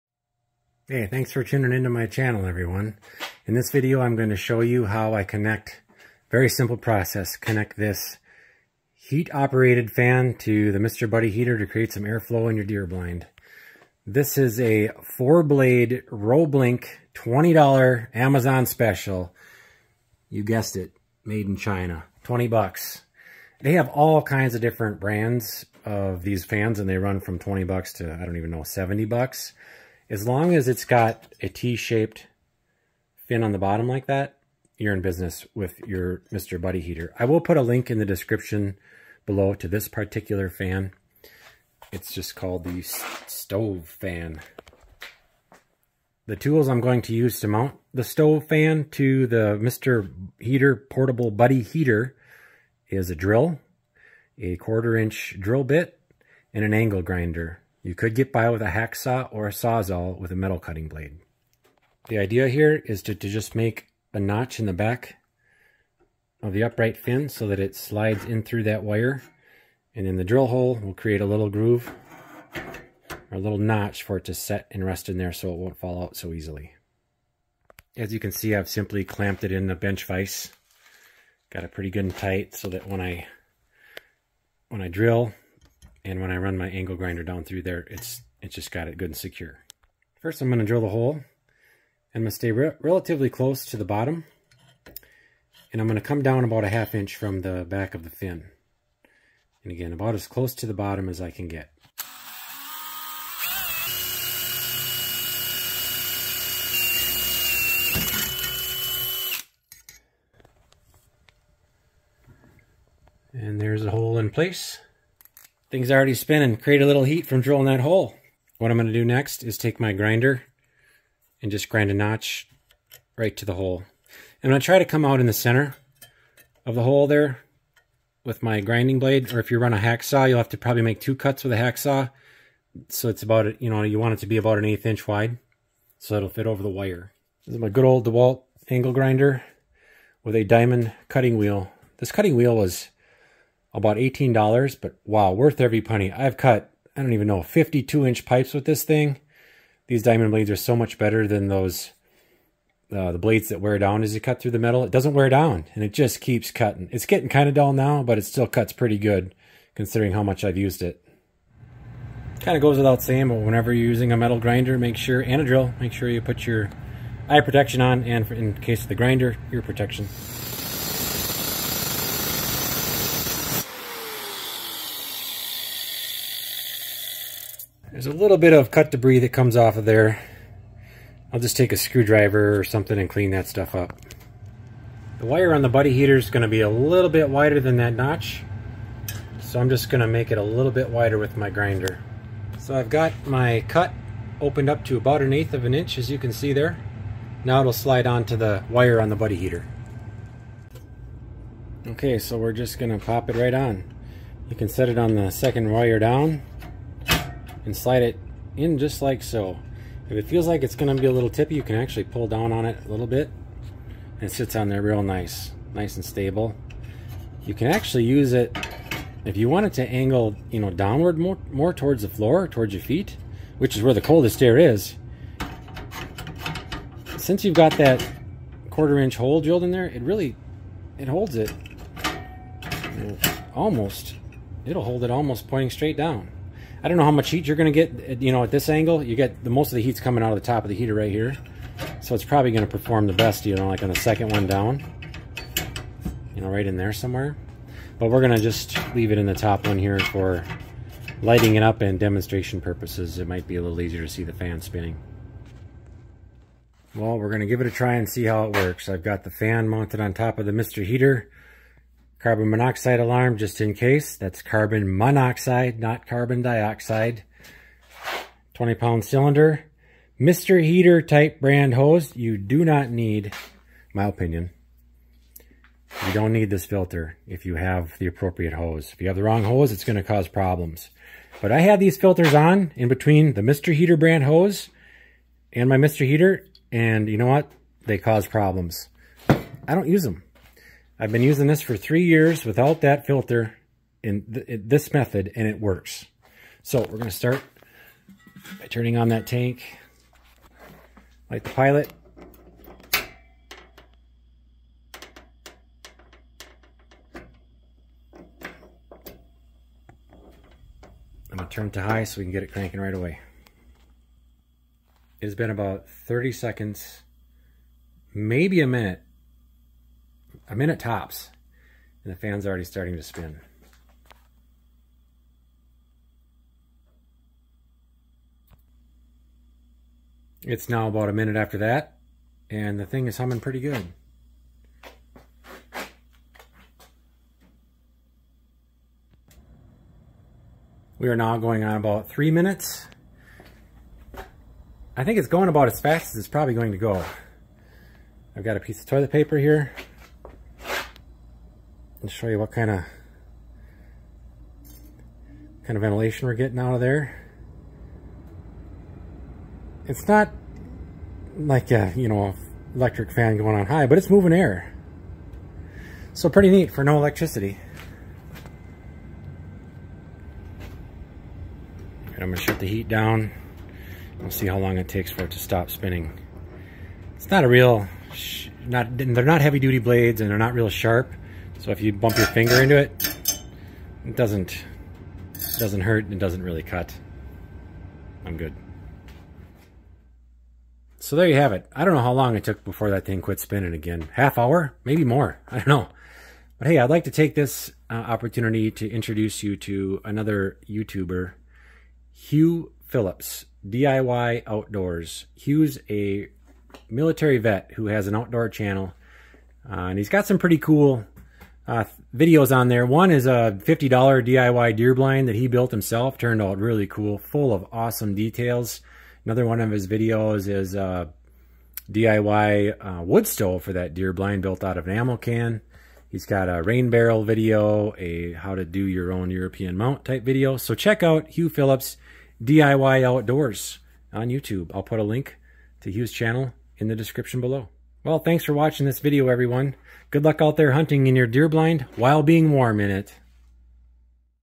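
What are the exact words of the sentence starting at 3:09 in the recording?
So I'm just going to make it a little bit wider with my grinder.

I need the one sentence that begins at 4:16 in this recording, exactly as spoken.
Well, we're going to give it a try and see how it works.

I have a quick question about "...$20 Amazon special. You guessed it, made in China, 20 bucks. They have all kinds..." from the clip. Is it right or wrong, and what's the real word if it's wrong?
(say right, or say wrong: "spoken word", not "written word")
right.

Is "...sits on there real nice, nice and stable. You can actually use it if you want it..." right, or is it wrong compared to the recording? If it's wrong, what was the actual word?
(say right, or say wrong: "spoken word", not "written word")
right.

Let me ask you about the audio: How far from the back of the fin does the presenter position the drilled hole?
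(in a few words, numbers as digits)
half inch.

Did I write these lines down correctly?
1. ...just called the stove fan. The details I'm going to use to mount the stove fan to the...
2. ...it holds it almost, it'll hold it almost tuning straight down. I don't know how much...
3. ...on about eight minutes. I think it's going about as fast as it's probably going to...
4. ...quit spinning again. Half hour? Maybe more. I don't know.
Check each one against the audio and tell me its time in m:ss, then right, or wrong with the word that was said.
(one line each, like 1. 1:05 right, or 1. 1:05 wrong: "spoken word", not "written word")
1. 0:42 wrong: "tools", not "details"
2. 3:50 wrong: "pointing", not "tuning"
3. 5:41 wrong: "three", not "eight"
4. 6:33 right.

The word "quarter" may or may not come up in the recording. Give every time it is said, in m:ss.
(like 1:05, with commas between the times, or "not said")
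0:54, 3:48.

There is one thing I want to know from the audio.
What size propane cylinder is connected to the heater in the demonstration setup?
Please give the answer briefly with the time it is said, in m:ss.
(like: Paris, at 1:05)
20 pound, at 4:28.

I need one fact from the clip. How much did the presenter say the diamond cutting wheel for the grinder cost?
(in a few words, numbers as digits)
$18.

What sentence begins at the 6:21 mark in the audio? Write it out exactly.
So if you bump your finger into it, it doesn't, it doesn't hurt and it doesn't really cut.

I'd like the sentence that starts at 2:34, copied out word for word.
It doesn't wear down and it just keeps cutting.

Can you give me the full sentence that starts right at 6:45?
Hugh's a military vet who has an outdoor channel, uh, and he's got some pretty cool uh, videos on there.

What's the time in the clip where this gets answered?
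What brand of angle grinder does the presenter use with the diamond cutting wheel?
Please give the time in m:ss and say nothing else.
2:18.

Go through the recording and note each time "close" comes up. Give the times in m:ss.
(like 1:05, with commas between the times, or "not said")
1:33, 1:40.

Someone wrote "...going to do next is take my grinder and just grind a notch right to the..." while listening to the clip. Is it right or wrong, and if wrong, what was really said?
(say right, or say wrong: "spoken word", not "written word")
right.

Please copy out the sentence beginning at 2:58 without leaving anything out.
There's a little bit of cut debris that comes off of there.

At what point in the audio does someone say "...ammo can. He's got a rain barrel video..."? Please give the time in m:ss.
7:04.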